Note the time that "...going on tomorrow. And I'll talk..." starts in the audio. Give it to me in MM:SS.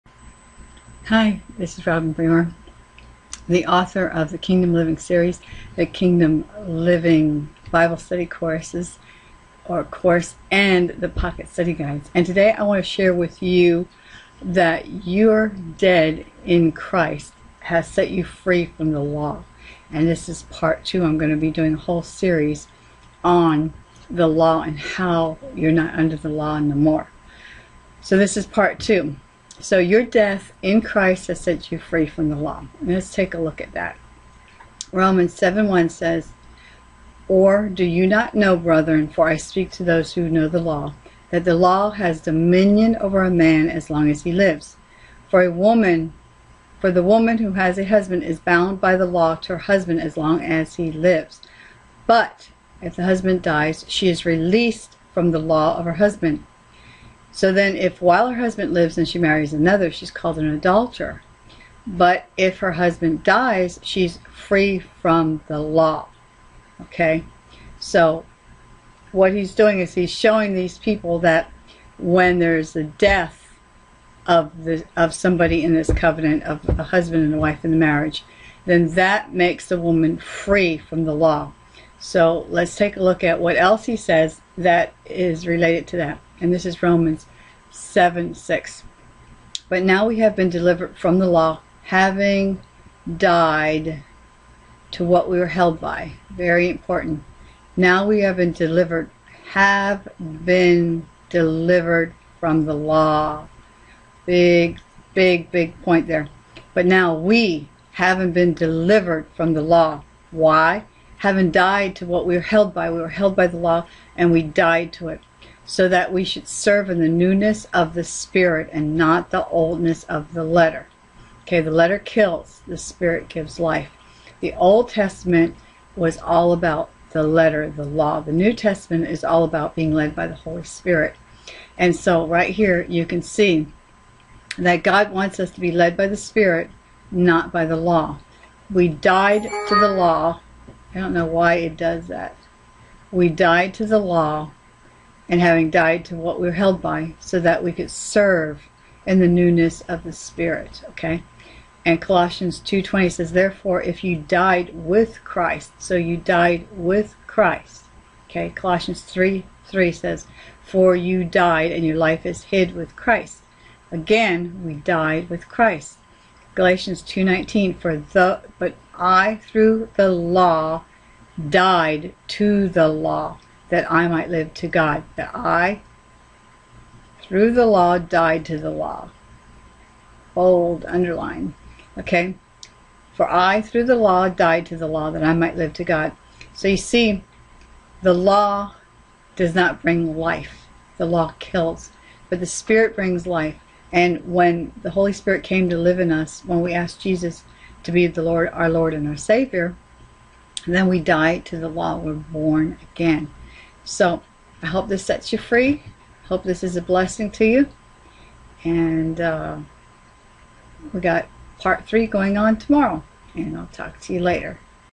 03:32.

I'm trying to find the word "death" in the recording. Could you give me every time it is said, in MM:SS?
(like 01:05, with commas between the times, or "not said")
00:30, 01:12.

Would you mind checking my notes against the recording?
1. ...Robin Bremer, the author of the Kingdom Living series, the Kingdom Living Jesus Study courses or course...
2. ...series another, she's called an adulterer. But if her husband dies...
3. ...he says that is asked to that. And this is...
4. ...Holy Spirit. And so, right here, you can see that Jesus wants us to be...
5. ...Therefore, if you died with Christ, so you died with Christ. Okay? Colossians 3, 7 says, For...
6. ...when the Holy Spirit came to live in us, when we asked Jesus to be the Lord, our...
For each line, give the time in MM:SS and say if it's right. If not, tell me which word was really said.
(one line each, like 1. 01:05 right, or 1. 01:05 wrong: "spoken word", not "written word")
1. 00:01 wrong: "Bible", not "Jesus"
2. 00:59 wrong: "marries", not "series"
3. 01:23 wrong: "related", not "asked"
4. 02:10 wrong: "God", not "Jesus"
5. 02:33 wrong: "3", not "7"
6. 03:14 right.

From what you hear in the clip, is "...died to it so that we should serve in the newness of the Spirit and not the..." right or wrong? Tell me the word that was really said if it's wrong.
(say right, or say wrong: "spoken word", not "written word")
right.